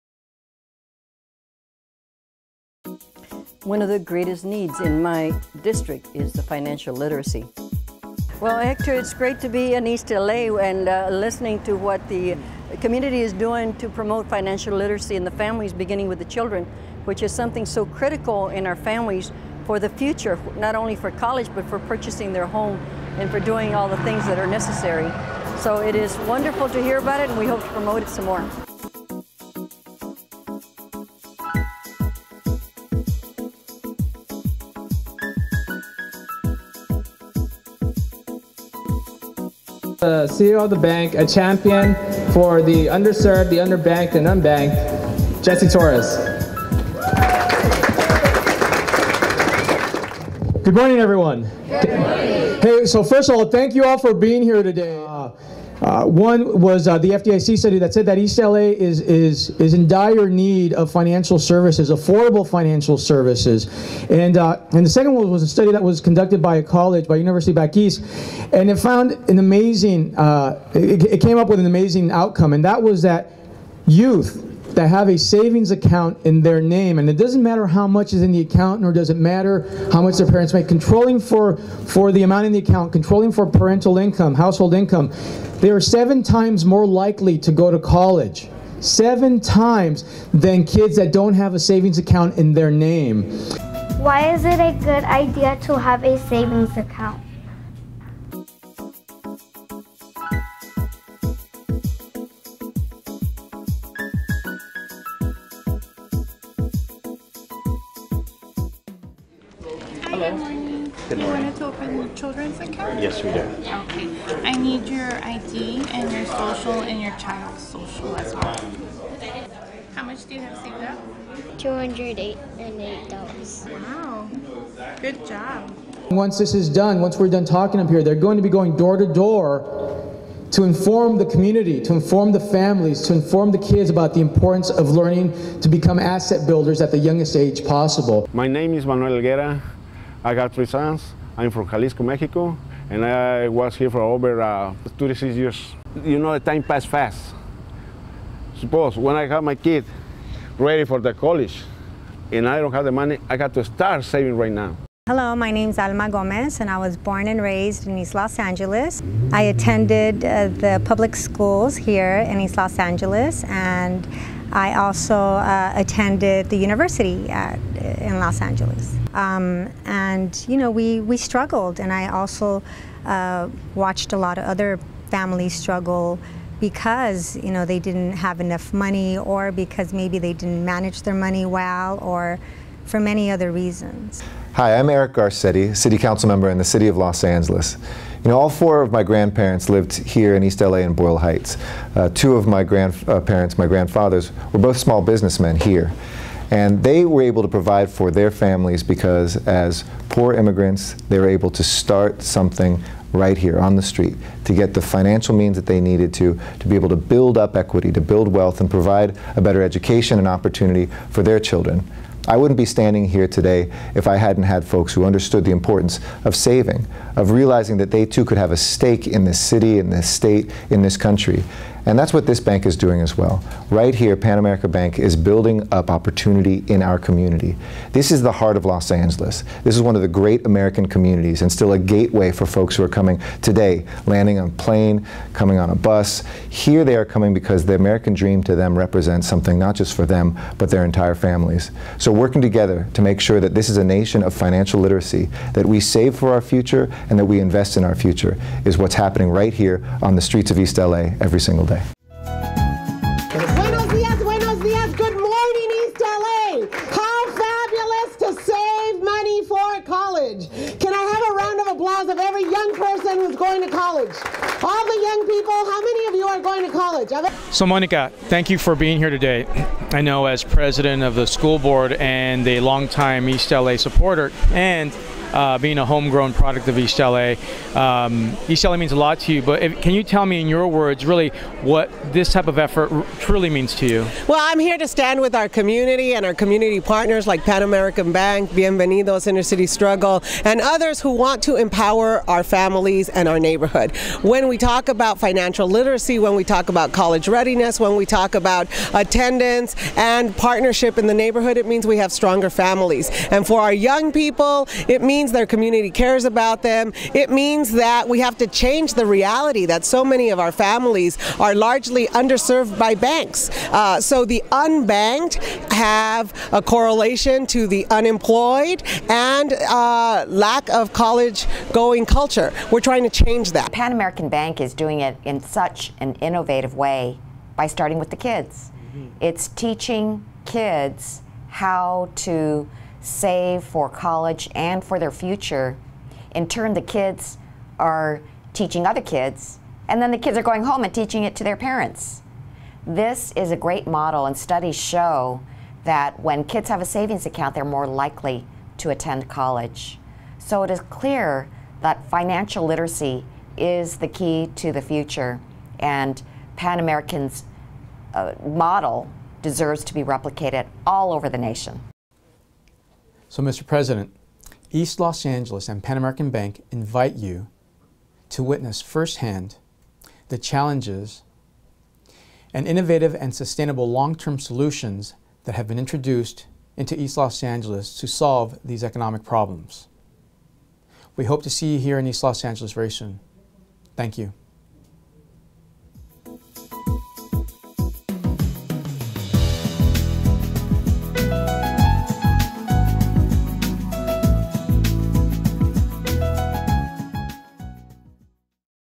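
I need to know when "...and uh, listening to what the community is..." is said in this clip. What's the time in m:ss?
0:10.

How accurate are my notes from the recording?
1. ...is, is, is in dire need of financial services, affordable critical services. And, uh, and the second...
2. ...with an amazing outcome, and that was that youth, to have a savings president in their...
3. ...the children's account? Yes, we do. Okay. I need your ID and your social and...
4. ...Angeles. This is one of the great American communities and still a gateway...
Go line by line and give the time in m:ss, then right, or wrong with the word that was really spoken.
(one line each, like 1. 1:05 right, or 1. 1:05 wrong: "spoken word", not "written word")
1. 0:58 wrong: "financial", not "critical"
2. 1:11 wrong: "account", not "president"
3. 1:51 right
4. 3:48 right.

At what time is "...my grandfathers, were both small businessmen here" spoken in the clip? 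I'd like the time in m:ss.
3:13.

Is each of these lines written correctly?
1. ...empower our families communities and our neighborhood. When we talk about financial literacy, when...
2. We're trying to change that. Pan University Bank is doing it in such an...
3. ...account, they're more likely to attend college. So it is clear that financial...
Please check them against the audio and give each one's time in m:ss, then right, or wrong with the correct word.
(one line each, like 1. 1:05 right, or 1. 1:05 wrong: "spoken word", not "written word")
1. 4:51 right
2. 5:22 wrong: "American", not "University"
3. 5:47 right.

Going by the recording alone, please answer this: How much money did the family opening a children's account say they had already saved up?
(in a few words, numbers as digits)
$208.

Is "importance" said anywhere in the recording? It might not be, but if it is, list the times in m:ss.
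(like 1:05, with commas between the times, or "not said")
2:14, 3:35.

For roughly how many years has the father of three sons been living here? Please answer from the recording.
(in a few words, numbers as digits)
36.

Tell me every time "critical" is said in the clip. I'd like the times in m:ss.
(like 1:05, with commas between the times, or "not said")
0:17.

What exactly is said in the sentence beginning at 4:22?
of every young person who's going to college.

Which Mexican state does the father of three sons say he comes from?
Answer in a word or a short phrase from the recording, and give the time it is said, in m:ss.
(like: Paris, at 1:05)
Jalisco, at 2:21.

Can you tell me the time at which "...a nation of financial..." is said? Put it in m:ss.
4:03.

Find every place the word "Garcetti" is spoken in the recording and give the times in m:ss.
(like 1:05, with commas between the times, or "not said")
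3:05.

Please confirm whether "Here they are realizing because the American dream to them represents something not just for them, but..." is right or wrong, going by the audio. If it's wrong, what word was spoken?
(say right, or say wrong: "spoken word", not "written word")
wrong: "coming", not "realizing".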